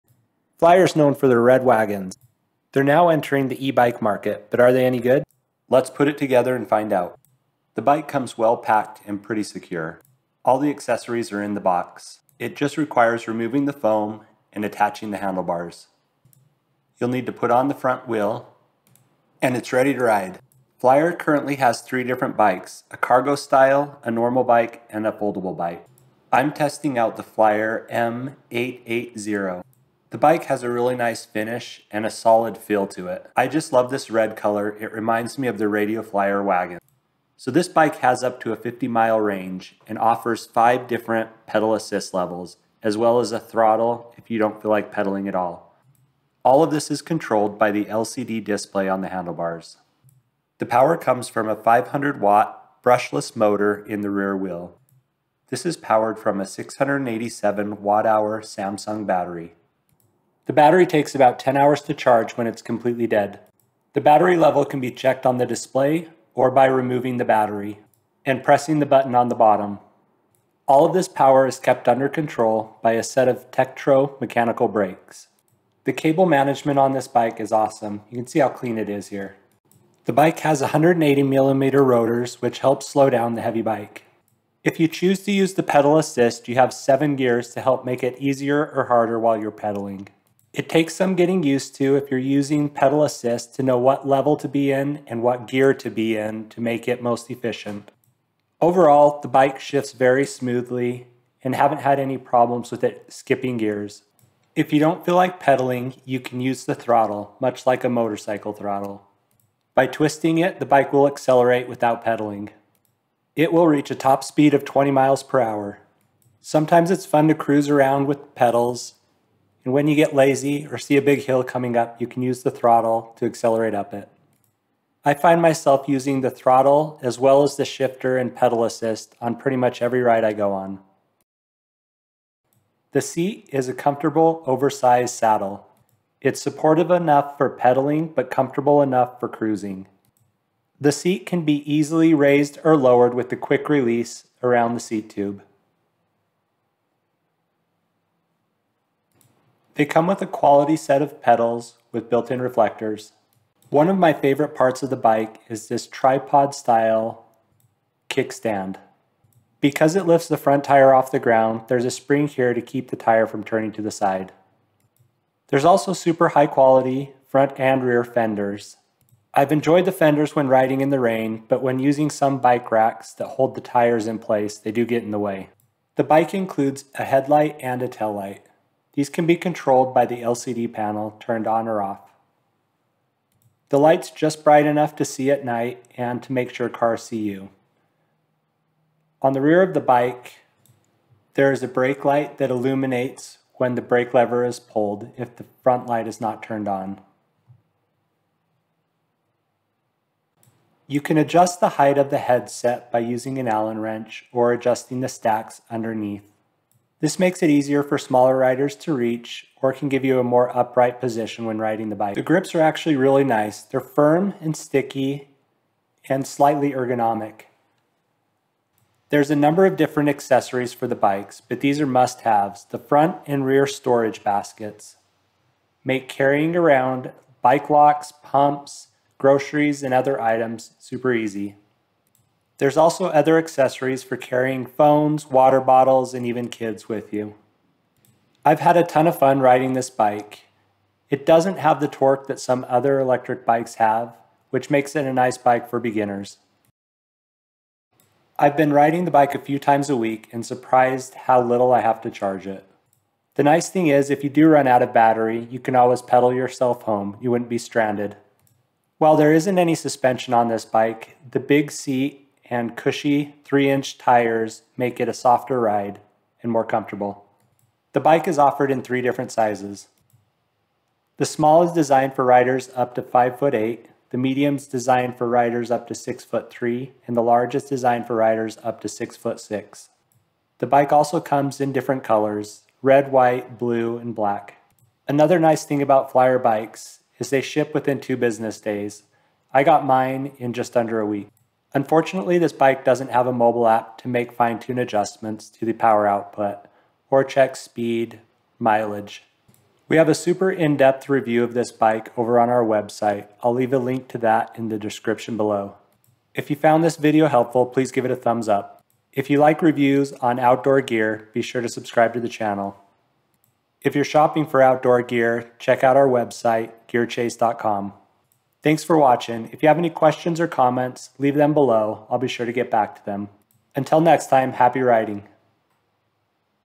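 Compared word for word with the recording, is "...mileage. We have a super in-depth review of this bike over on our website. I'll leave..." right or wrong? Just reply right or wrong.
right.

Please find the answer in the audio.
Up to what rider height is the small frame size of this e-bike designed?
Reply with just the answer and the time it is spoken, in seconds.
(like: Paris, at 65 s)
5 foot 8, at 273 s.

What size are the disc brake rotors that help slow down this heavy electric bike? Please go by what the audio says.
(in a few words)
180 millimeters.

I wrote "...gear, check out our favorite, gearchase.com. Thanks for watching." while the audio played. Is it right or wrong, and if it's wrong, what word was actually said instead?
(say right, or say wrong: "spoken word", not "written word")
wrong: "website", not "favorite".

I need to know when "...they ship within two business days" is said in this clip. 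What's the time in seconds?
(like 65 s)
287 s.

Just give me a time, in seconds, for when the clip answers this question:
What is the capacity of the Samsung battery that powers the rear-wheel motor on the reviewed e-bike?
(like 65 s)
56 s.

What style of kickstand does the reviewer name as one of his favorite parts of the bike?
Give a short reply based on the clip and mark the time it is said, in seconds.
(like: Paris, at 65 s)
Tripod, at 155 s.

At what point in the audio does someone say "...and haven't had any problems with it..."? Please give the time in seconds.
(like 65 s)
101 s.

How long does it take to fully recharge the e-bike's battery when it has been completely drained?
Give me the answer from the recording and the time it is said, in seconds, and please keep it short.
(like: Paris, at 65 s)
10 hours, at 61 s.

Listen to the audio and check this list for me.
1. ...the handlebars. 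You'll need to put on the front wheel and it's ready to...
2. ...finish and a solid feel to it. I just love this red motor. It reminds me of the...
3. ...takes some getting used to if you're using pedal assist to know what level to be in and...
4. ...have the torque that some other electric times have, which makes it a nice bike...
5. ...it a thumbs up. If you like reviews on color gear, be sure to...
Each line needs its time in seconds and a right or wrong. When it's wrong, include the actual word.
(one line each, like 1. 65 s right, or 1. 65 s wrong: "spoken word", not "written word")
1. 15 s right
2. 31 s wrong: "color", not "motor"
3. 90 s right
4. 241 s wrong: "bikes", not "times"
5. 308 s wrong: "outdoor", not "color".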